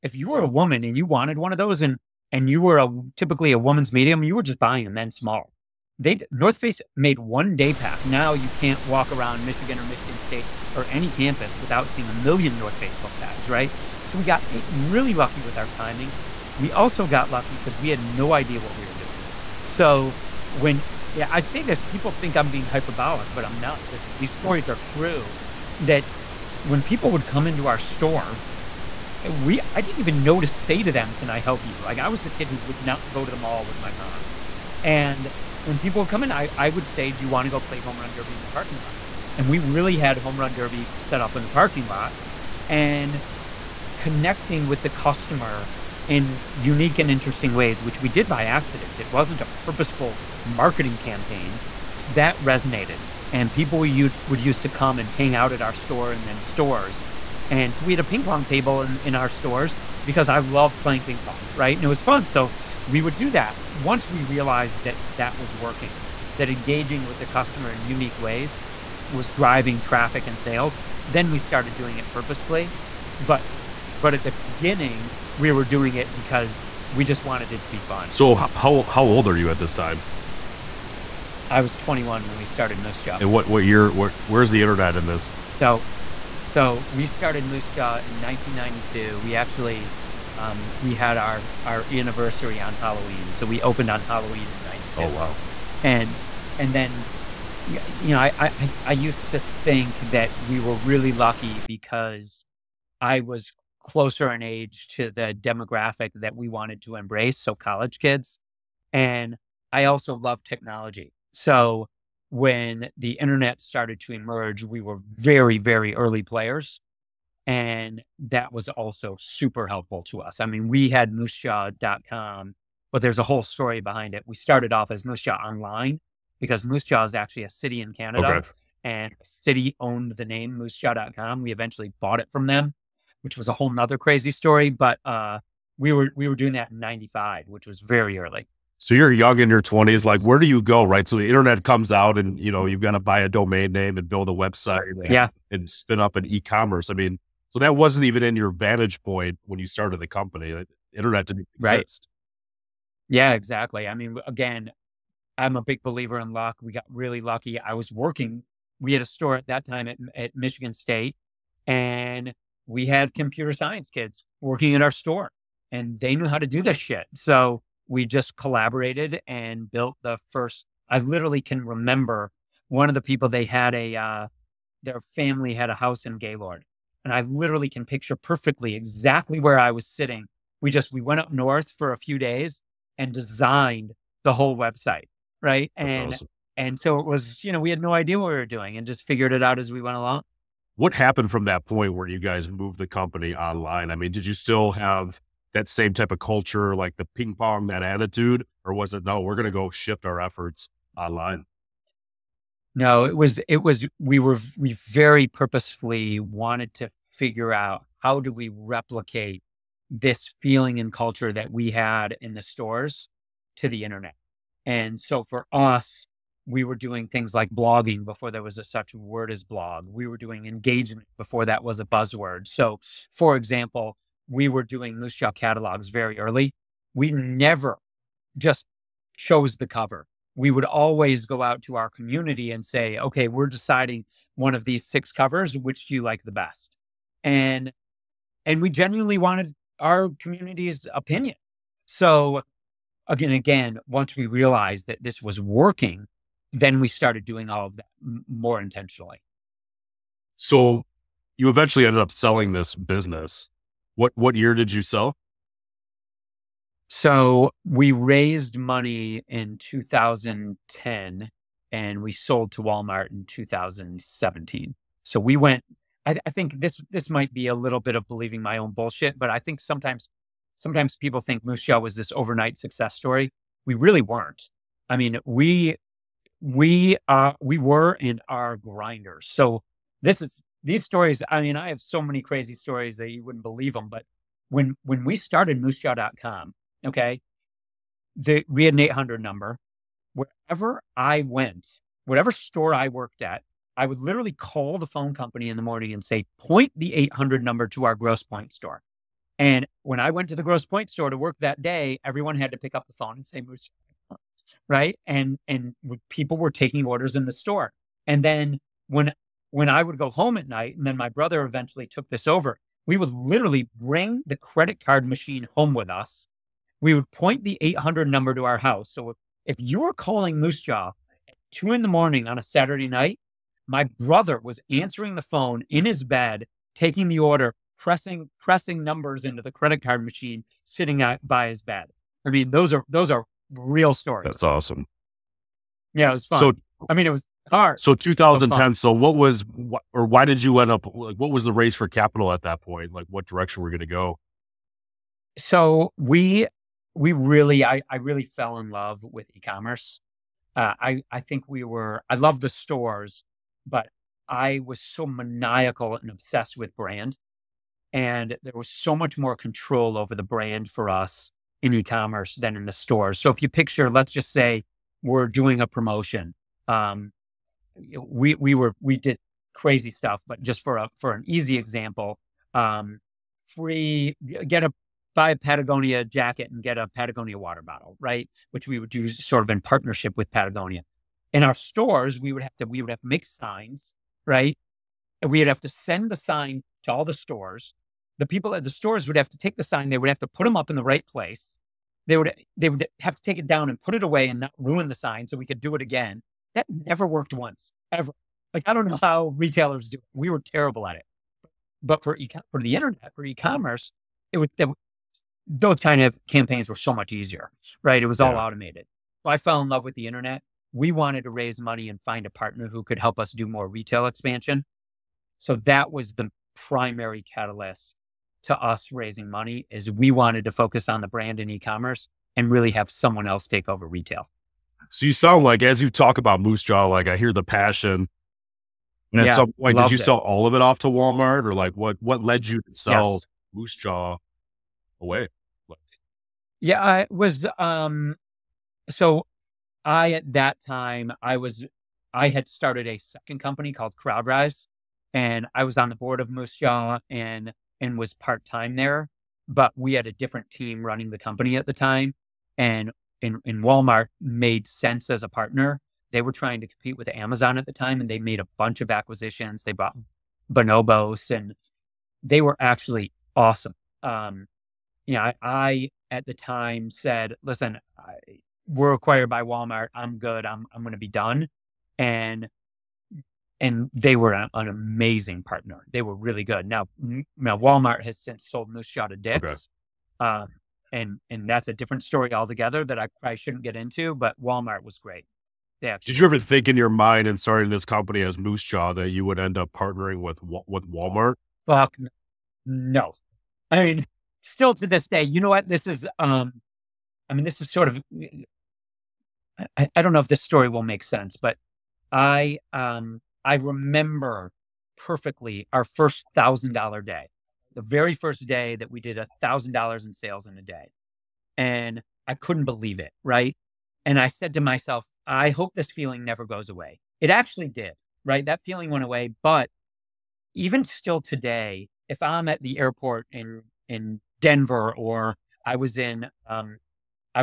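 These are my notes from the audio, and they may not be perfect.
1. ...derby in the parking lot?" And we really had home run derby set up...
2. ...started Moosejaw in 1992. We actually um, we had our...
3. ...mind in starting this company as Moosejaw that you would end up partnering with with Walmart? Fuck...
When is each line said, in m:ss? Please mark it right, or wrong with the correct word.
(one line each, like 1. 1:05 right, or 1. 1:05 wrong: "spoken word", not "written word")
1. 0:38 right
2. 1:27 right
3. 8:06 right.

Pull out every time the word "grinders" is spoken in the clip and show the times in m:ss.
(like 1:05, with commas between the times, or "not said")
4:38.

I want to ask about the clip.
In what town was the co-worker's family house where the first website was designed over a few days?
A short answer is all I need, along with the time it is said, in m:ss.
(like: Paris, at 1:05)
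Gaylord, at 2:56.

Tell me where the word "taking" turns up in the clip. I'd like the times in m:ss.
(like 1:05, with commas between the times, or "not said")
5:06, 5:26.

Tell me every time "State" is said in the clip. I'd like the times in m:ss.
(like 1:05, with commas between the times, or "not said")
0:10, 2:40.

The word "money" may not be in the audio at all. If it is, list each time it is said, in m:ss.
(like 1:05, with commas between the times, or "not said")
4:18, 6:51, 6:59.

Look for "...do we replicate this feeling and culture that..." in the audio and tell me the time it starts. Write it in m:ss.
3:28.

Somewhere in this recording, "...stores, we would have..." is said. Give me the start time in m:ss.
6:21.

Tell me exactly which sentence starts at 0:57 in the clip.
And so we had a ping pong table in, in our stores because I love playing ping pong, right?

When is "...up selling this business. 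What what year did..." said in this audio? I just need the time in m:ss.
4:12.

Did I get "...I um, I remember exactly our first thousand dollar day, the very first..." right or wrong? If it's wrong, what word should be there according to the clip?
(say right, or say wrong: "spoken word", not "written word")
wrong: "perfectly", not "exactly".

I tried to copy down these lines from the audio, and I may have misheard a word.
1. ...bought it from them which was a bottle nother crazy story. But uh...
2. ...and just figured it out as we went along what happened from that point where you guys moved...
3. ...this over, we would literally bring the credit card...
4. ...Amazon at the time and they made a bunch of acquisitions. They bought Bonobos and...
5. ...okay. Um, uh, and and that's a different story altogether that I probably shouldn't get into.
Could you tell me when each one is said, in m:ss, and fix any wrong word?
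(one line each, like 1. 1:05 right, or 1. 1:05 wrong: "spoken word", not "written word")
1. 2:12 wrong: "whole", not "bottle"
2. 3:08 right
3. 5:12 right
4. 7:37 right
5. 8:00 right.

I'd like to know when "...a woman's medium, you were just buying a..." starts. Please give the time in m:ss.
0:03.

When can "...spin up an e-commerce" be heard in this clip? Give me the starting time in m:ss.
2:25.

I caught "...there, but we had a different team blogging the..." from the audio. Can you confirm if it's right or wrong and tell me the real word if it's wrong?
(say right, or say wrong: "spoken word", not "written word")
wrong: "running", not "blogging".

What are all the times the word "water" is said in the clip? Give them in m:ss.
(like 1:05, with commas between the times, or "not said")
6:17.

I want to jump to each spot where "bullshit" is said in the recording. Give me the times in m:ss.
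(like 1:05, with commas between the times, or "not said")
4:28.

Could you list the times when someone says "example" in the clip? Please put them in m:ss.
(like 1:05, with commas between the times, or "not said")
3:43, 6:11.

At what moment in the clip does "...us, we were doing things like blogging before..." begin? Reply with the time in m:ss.
3:35.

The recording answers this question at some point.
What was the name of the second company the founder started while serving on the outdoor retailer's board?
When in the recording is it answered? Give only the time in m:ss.
7:23.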